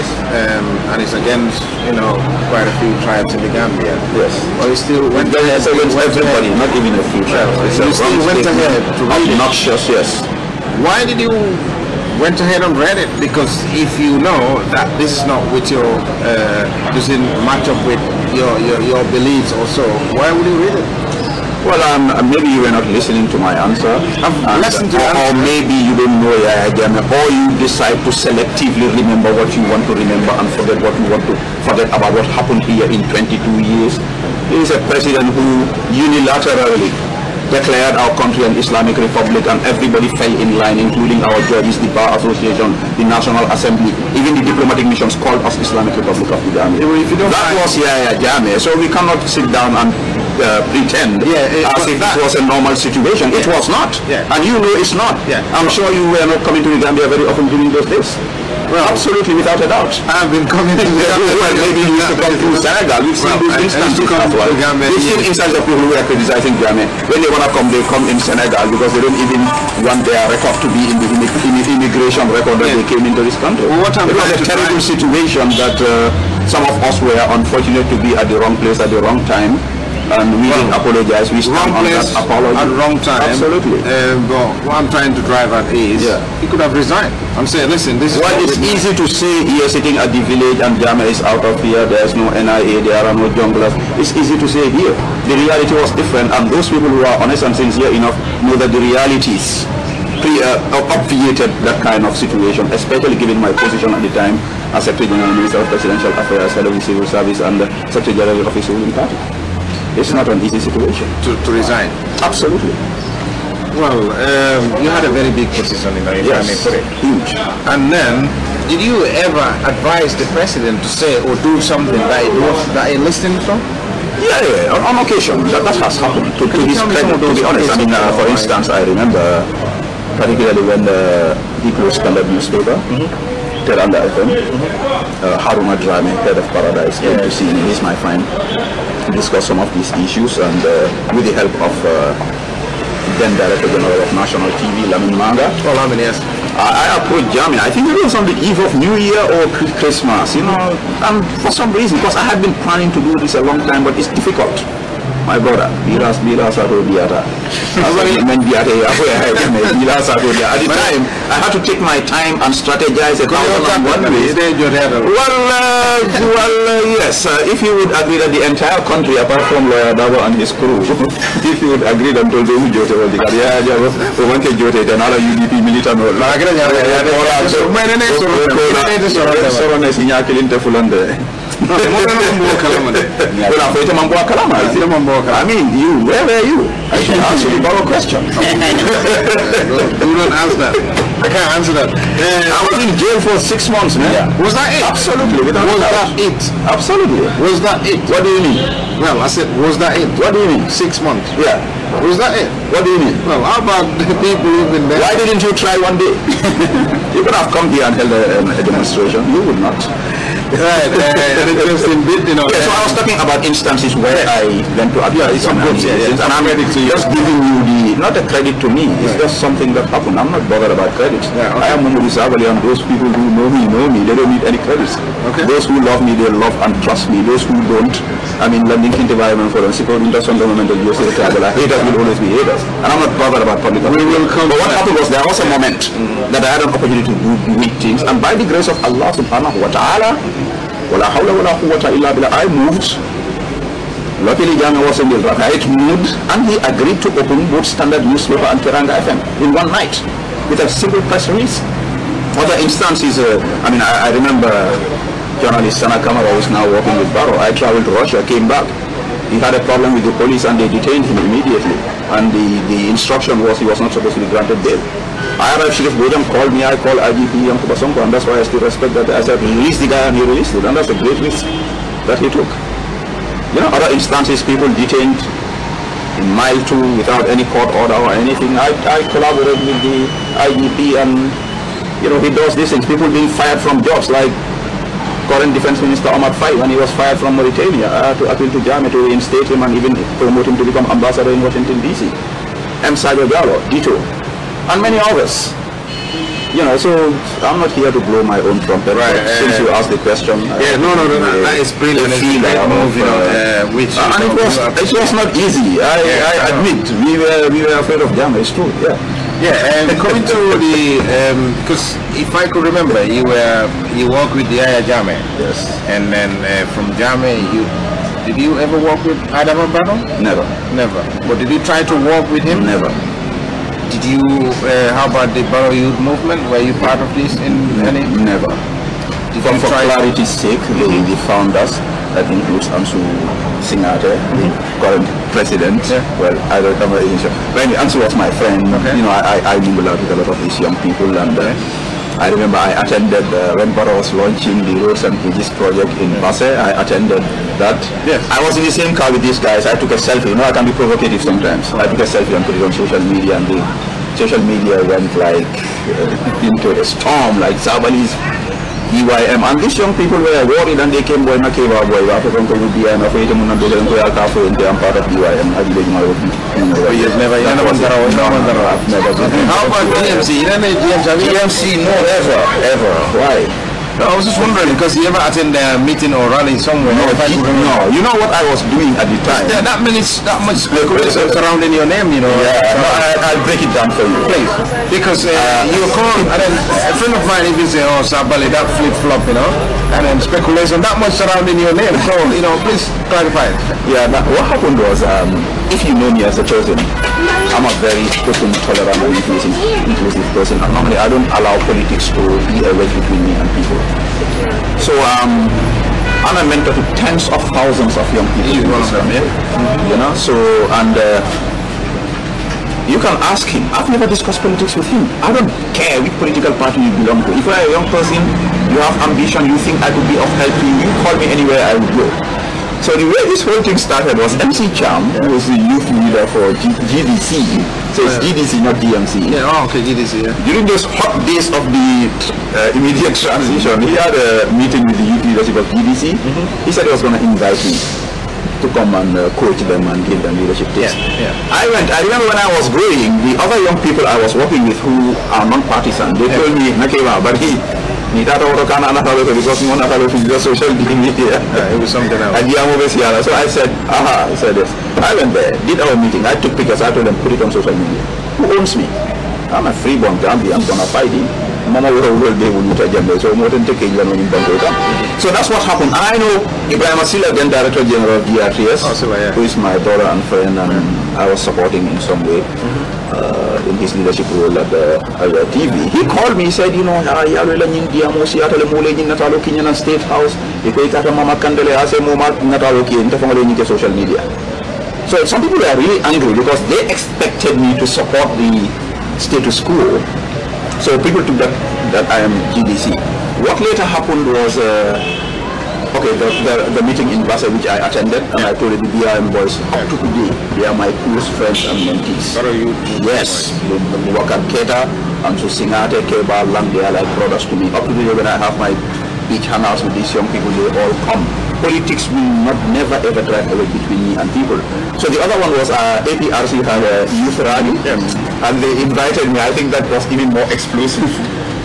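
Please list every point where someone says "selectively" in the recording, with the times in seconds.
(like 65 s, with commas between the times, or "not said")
28 s.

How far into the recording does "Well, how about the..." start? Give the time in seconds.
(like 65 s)
203 s.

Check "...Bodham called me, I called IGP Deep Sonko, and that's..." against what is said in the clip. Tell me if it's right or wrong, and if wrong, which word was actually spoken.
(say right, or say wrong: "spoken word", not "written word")
wrong: "Yankuba", not "Deep".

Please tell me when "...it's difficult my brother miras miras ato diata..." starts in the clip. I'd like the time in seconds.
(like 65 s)
153 s.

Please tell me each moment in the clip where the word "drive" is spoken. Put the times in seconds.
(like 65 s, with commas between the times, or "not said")
85 s, 513 s.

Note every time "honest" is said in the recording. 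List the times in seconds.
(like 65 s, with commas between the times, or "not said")
97 s, 127 s.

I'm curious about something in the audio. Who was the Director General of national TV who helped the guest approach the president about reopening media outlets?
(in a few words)
Lamin Manga.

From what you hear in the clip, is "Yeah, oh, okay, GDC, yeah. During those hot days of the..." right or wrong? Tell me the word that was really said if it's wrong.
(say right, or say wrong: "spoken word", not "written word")
right.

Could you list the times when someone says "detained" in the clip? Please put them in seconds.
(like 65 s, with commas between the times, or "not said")
260 s, 274 s.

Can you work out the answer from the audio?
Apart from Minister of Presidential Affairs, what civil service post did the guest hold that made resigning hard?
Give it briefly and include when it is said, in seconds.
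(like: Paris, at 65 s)
Head of the Civil Service, at 106 s.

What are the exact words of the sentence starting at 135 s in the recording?
Haruma uh, head of Paradise, came yeah.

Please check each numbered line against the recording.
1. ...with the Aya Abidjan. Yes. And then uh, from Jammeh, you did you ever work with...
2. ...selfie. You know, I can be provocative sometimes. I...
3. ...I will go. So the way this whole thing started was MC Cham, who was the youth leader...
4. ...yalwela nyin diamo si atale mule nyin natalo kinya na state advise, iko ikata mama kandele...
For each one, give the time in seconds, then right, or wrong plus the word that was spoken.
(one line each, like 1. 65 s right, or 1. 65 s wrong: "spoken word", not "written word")
1. 314 s wrong: "Jammeh", not "Abidjan"
2. 349 s right
3. 421 s right
4. 477 s wrong: "house", not "advise".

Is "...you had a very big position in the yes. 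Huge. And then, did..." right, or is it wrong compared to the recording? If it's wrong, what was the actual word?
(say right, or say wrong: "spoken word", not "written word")
right.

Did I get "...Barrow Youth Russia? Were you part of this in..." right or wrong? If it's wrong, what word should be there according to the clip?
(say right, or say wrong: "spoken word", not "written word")
wrong: "Movement", not "Russia".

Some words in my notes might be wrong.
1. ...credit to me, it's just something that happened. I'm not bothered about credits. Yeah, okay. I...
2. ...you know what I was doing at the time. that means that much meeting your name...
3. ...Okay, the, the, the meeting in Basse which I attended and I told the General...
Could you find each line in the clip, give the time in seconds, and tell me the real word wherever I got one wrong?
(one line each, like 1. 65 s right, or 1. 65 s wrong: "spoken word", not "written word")
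1. 218 s right
2. 377 s wrong: "surrounding", not "meeting"
3. 495 s wrong: "BRM", not "General".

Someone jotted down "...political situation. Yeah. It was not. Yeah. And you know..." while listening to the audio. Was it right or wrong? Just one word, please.
wrong.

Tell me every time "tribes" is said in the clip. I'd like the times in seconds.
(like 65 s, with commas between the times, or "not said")
3 s, 7 s.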